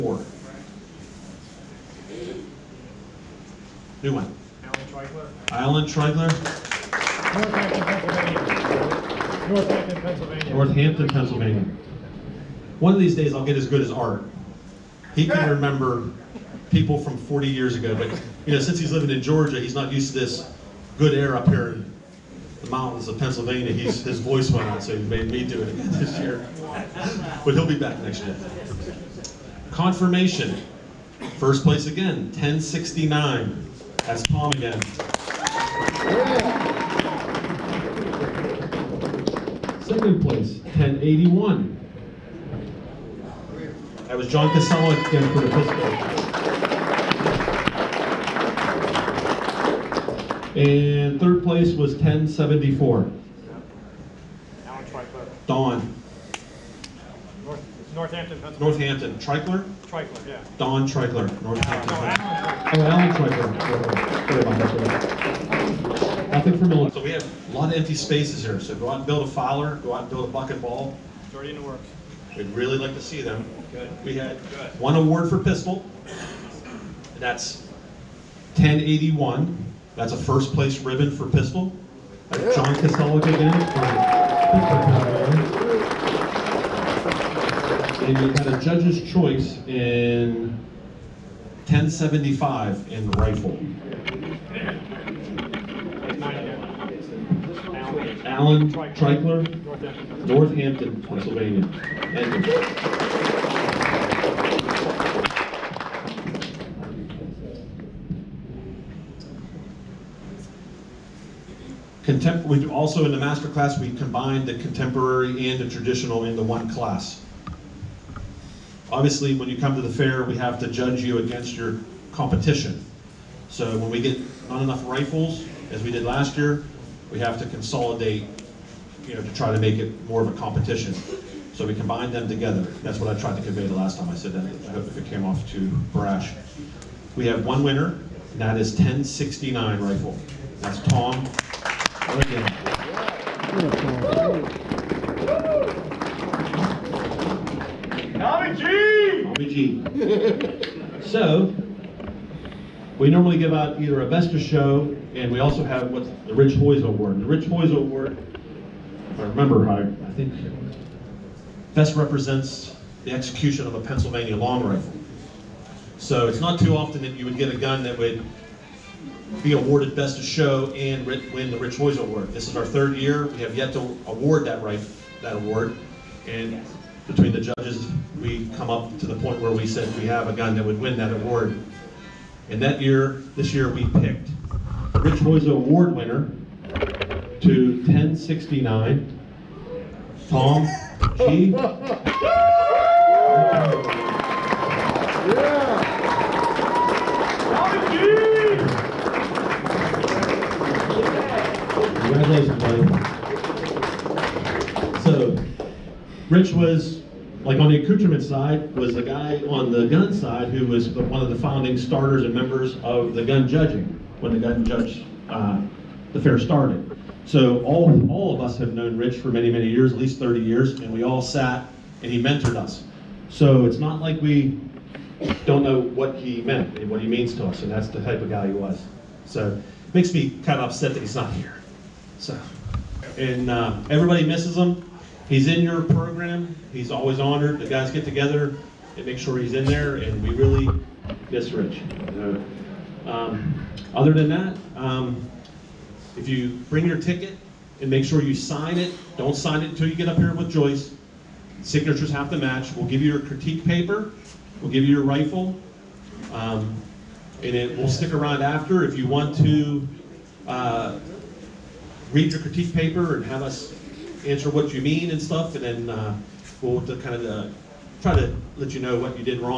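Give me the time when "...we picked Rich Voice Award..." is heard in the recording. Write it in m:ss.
3:03.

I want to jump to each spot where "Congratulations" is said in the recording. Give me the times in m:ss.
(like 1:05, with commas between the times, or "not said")
3:22.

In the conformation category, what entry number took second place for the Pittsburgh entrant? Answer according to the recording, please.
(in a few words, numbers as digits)
1081.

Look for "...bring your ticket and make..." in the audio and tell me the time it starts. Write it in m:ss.
4:06.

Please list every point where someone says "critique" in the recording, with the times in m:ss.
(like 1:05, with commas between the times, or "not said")
4:13, 4:22.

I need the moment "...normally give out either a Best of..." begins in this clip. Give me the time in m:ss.
2:33.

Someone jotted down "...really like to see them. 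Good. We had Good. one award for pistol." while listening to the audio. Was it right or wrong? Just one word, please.
right.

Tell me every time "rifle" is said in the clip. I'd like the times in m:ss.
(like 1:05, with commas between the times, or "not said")
1:33, 2:04, 2:19, 2:44, 4:15.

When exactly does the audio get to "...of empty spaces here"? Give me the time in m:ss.
1:07.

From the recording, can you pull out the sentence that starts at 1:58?
Obviously, when you come to the fair, we have to judge you against your competition.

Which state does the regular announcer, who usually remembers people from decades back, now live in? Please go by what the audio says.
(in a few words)
Georgia.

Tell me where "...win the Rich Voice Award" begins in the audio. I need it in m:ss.
2:51.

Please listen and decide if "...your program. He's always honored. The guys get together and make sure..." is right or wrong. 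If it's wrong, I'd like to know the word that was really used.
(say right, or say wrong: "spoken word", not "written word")
right.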